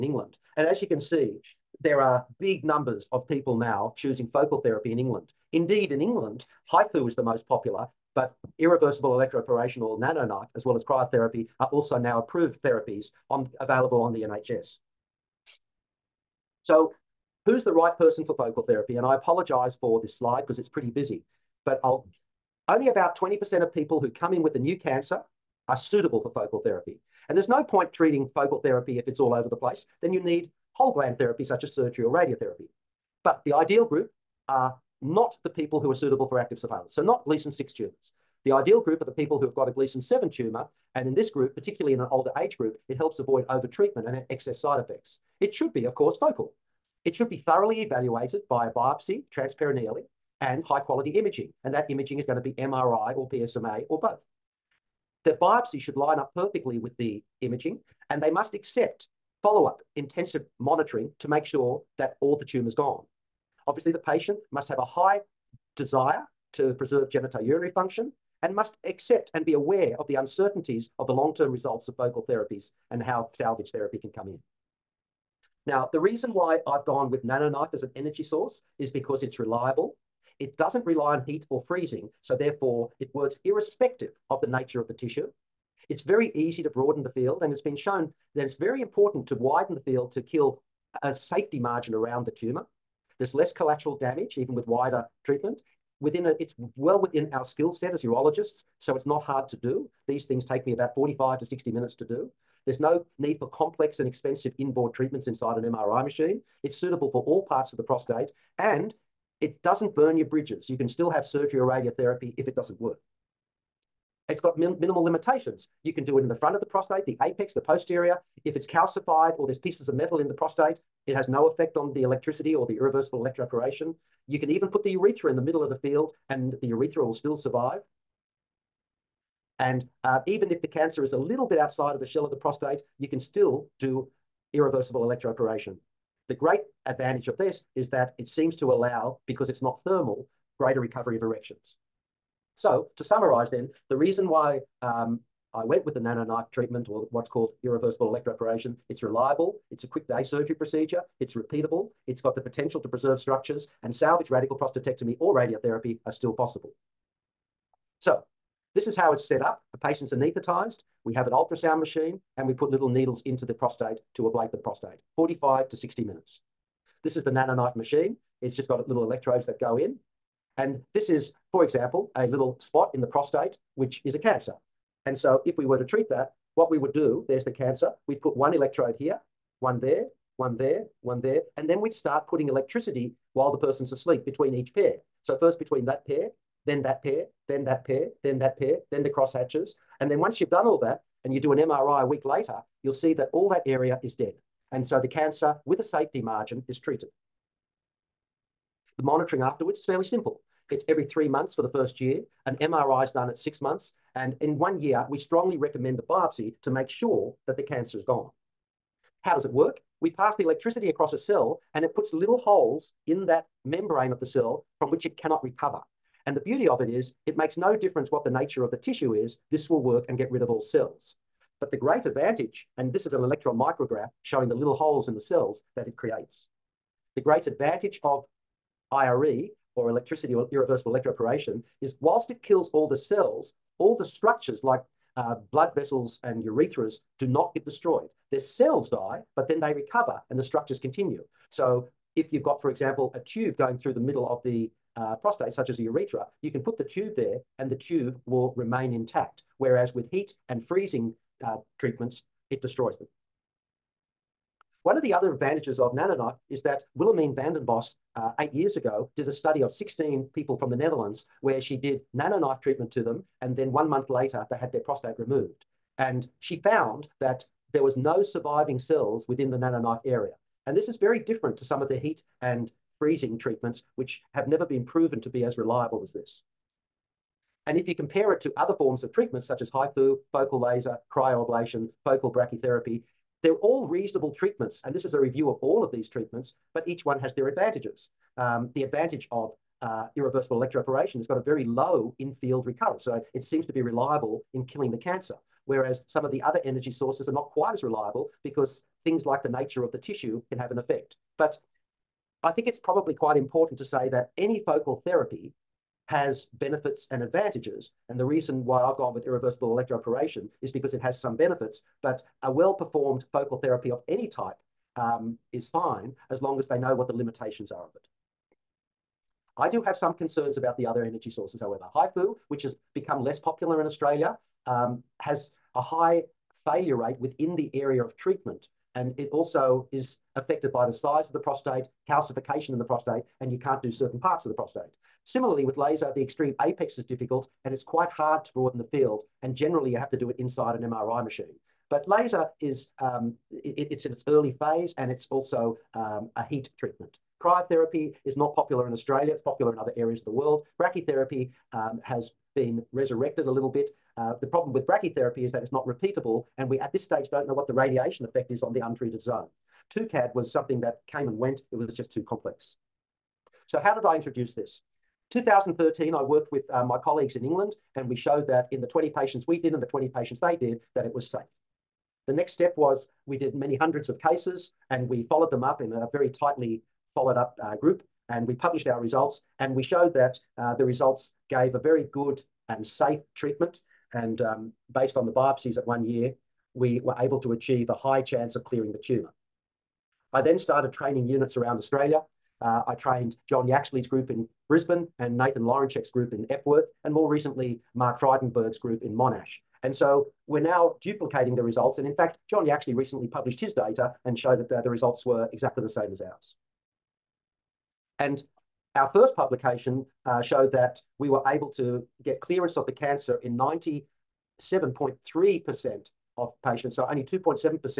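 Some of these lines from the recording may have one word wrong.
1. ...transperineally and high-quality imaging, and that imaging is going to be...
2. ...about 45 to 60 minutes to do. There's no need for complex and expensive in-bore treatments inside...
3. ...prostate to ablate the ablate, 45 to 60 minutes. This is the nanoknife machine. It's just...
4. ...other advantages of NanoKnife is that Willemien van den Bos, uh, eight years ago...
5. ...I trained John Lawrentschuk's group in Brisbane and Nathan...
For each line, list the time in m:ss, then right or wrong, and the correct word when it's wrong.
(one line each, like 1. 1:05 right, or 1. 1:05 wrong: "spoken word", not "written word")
1. 0:49 right
2. 1:40 right
3. 2:43 wrong: "prostate", not "ablate"
4. 4:15 right
5. 6:32 wrong: "Yaxley", not "Lawrentschuk".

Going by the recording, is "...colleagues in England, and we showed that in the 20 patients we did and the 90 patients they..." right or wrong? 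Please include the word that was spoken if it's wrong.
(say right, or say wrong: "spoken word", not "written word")
wrong: "20", not "90".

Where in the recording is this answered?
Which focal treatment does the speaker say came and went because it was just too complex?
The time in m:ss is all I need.
5:59.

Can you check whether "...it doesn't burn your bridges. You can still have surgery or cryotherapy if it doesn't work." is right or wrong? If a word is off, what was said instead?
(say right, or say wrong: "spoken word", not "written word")
wrong: "radiotherapy", not "cryotherapy".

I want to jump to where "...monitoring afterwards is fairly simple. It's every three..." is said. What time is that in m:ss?
3:19.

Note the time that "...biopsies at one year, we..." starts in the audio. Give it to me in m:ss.
6:25.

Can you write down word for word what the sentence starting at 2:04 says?
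You can even put the urethra in the middle of the field and the urethra will still survive.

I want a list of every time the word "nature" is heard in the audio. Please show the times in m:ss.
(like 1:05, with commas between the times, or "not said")
1:24, 3:38, 4:59.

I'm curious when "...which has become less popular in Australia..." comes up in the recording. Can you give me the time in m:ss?
5:22.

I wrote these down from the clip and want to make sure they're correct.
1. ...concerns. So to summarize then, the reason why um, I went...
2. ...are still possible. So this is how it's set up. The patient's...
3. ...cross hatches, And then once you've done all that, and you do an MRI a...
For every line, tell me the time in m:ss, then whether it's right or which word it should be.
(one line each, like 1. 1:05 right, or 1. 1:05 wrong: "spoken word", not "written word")
1. 2:21 wrong: "erections", not "concerns"
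2. 2:36 right
3. 3:09 right.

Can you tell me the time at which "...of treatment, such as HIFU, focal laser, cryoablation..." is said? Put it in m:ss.
4:39.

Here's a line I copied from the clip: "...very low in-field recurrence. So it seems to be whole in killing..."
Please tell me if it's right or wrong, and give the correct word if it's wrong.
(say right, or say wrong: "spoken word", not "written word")
wrong: "reliable", not "whole".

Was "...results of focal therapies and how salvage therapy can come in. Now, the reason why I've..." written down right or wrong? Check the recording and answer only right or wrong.
right.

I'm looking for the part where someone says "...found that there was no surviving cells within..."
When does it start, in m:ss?
4:26.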